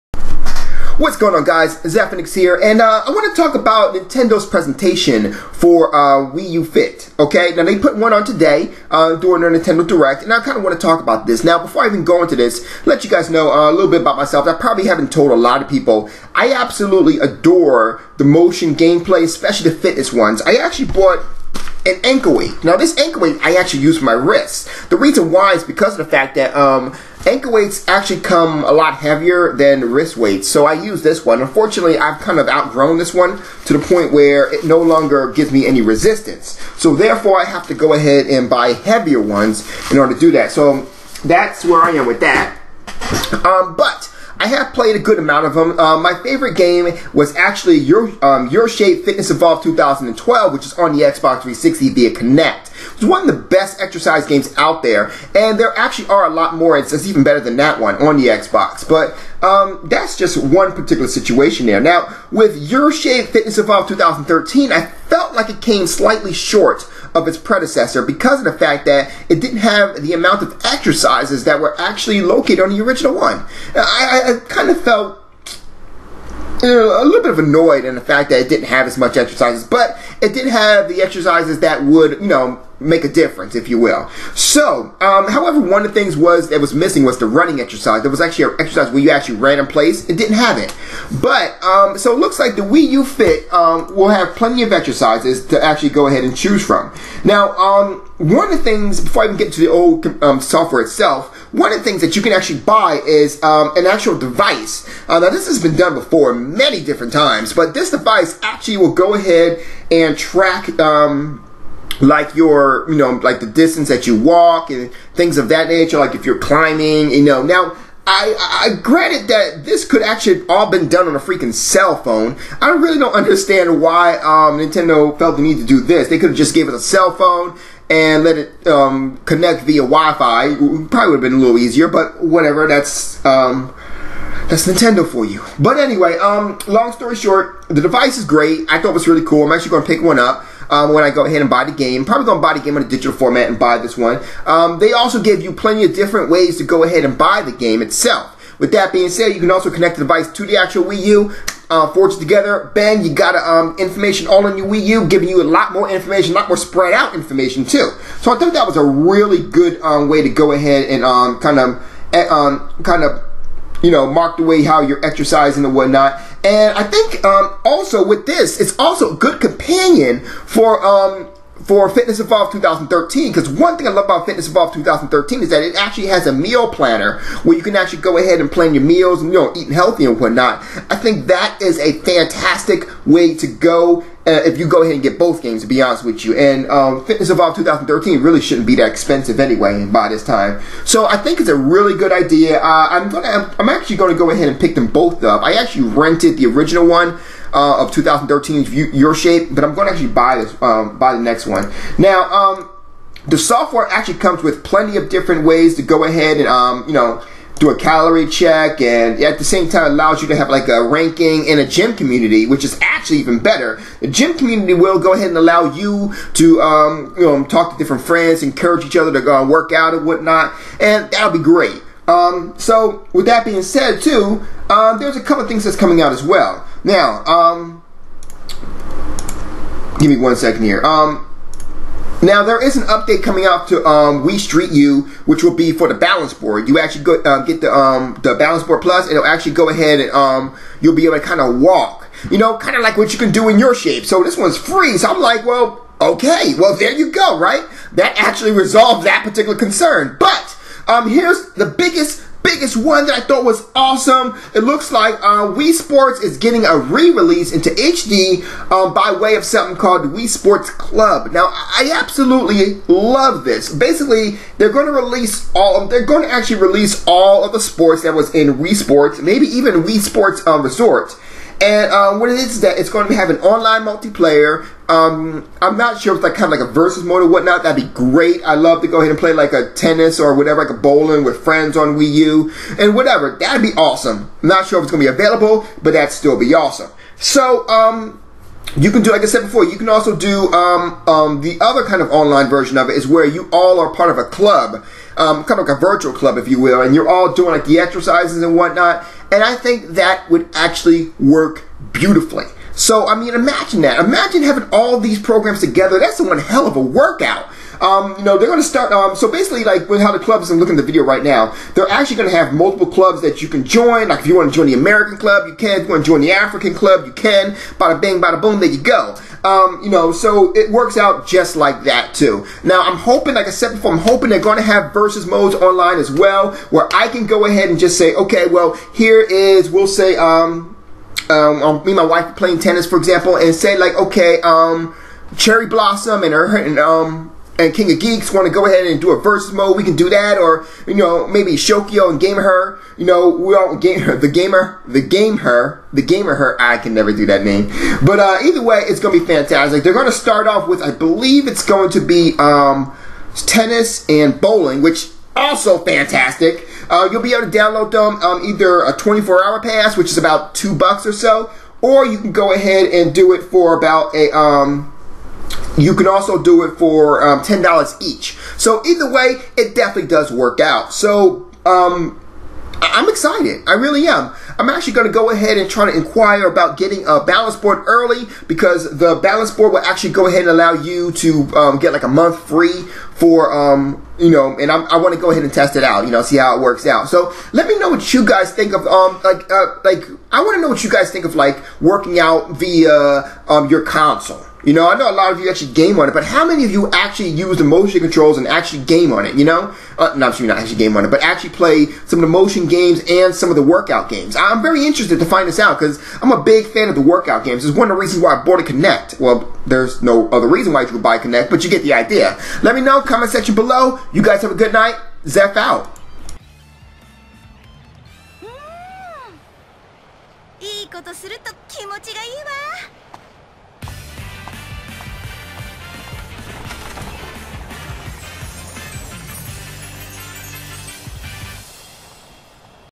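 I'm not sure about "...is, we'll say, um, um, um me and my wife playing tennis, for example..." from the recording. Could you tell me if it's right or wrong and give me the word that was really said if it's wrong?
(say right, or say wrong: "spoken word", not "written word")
right.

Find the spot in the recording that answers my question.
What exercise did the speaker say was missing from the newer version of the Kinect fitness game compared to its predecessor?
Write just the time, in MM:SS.
01:27.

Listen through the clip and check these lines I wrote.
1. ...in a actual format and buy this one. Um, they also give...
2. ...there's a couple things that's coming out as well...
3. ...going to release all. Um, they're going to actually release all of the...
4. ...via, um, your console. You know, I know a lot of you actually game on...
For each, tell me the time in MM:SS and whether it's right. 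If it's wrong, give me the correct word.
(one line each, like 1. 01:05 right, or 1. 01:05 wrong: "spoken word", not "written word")
1. 02:22 wrong: "digital", not "actual"
2. 03:44 right
3. 04:24 right
4. 06:32 right.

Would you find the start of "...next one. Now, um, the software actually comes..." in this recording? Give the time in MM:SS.
03:21.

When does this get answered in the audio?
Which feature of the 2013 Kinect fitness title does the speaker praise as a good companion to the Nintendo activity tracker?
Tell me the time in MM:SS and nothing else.
02:56.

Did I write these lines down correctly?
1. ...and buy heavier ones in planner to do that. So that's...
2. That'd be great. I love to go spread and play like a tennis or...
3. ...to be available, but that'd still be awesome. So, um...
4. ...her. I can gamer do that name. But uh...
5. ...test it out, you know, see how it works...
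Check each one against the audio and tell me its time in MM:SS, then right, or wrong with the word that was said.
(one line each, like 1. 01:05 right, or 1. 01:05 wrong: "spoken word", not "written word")
1. 00:38 wrong: "order", not "planner"
2. 04:37 wrong: "ahead", not "spread"
3. 04:45 right
4. 05:46 wrong: "never", not "gamer"
5. 06:25 right.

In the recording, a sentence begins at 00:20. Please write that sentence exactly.
I actually bought an ankle weight.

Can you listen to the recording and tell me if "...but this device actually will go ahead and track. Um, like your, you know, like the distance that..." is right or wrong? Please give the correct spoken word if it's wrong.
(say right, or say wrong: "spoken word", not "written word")
right.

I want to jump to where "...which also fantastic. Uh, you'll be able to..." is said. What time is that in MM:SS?
05:54.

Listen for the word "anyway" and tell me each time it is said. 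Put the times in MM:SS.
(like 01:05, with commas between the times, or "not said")
02:15, 03:09.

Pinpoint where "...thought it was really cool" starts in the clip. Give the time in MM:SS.
02:18.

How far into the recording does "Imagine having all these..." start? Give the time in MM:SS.
05:03.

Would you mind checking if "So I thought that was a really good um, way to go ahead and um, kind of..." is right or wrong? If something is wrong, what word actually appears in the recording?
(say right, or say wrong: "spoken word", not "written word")
right.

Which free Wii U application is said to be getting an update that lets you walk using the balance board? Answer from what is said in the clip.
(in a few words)
Wii Street U.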